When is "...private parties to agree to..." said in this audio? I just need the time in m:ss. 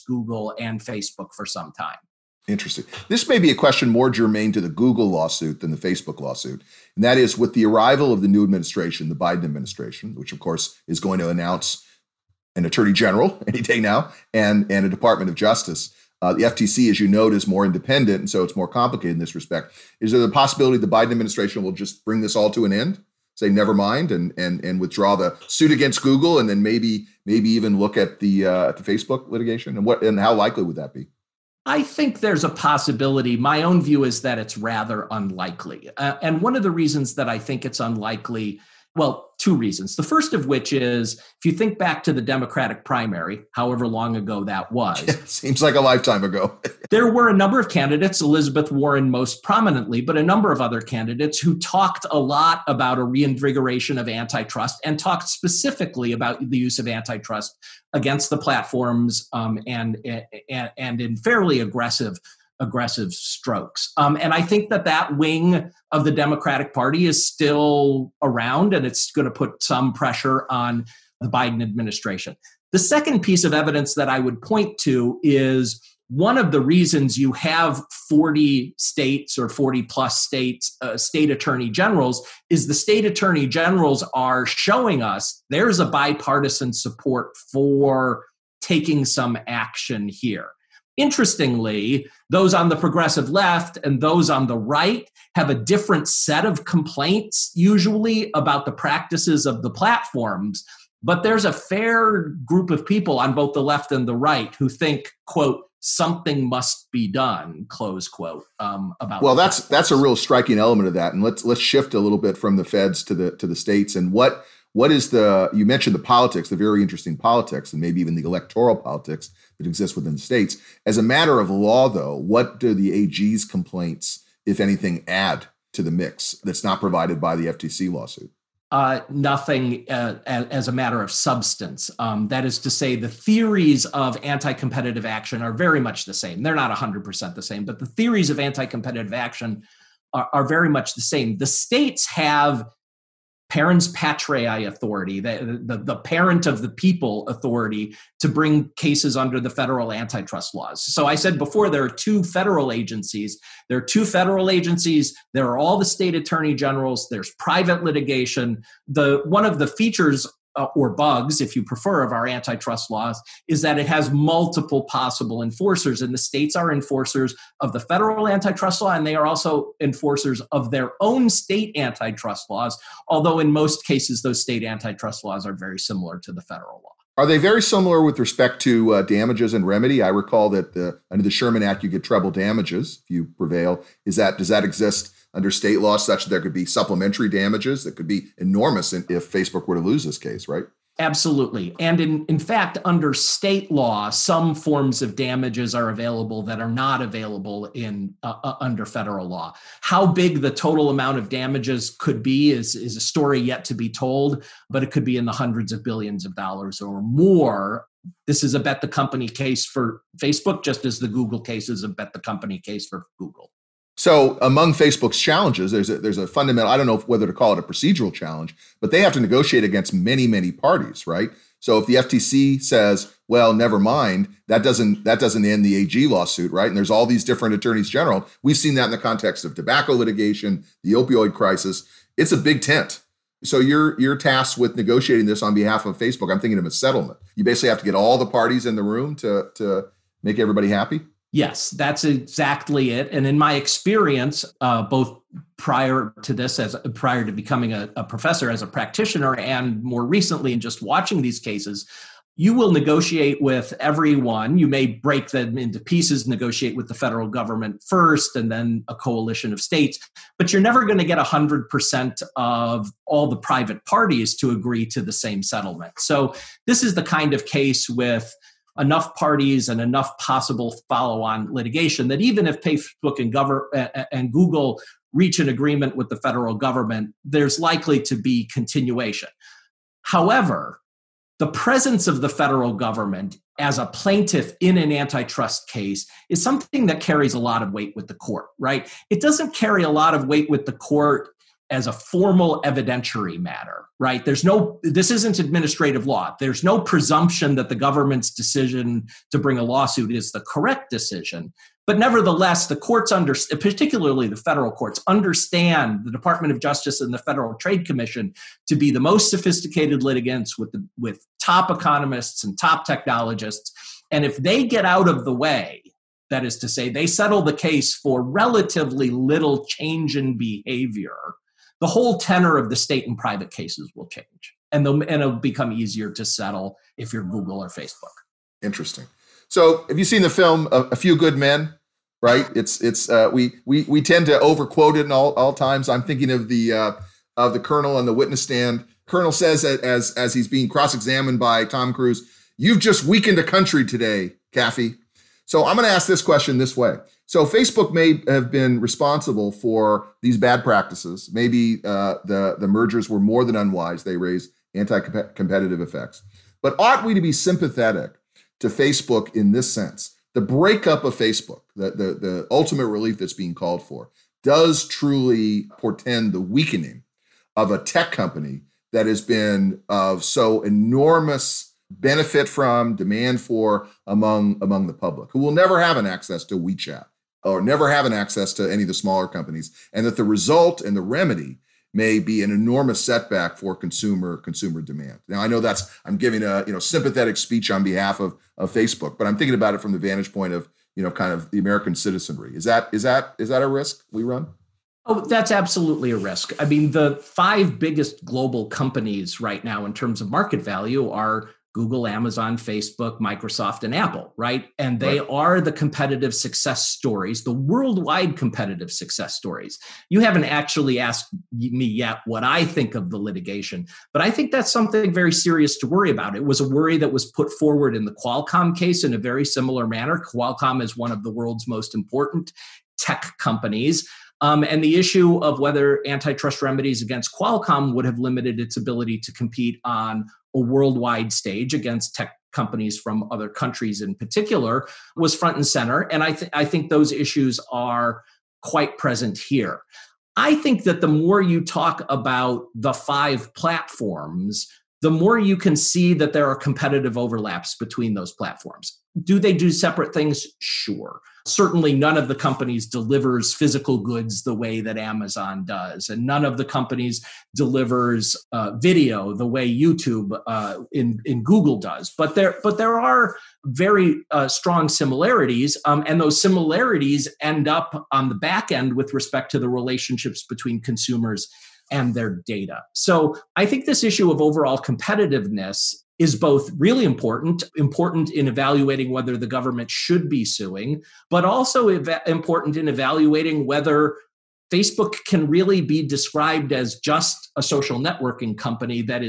4:23.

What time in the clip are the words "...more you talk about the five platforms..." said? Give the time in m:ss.
7:21.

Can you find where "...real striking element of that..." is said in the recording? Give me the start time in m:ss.
1:49.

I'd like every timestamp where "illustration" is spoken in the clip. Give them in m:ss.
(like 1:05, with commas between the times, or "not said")
not said.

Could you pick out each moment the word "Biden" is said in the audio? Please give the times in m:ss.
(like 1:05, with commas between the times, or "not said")
0:09, 0:20, 1:11.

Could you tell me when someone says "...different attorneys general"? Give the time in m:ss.
3:47.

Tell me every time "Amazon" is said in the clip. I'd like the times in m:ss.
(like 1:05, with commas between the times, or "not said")
6:42, 7:34.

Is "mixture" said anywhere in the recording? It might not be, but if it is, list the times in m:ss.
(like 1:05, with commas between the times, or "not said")
not said.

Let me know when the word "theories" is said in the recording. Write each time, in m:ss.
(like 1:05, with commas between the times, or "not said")
2:13, 2:17.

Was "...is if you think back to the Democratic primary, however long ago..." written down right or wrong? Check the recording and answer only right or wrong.
right.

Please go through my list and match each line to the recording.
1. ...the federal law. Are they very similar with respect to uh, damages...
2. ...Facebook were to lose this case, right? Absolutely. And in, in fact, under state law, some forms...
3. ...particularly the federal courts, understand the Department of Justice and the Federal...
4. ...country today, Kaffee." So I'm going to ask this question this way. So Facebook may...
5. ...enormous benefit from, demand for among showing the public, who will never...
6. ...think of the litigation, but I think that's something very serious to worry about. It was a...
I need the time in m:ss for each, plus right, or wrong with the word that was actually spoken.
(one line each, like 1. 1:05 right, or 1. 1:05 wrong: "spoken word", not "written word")
1. 2:56 right
2. 3:09 right
3. 5:03 right
4. 5:43 right
5. 6:10 wrong: "among", not "showing"
6. 6:52 right.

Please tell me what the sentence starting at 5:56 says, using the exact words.
But ought we to be sympathetic to Facebook in this sense?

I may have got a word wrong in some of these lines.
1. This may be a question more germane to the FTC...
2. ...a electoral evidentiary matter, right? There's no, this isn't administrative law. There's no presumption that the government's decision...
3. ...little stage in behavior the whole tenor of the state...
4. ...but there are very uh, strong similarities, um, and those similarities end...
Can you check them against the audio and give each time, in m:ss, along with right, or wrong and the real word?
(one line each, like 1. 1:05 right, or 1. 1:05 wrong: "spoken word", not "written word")
1. 0:03 wrong: "Google", not "FTC"
2. 4:51 wrong: "formal", not "electoral"
3. 5:19 wrong: "change", not "stage"
4. 7:42 right.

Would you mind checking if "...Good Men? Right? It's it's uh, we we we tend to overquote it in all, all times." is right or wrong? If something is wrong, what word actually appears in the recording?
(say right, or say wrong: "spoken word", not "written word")
right.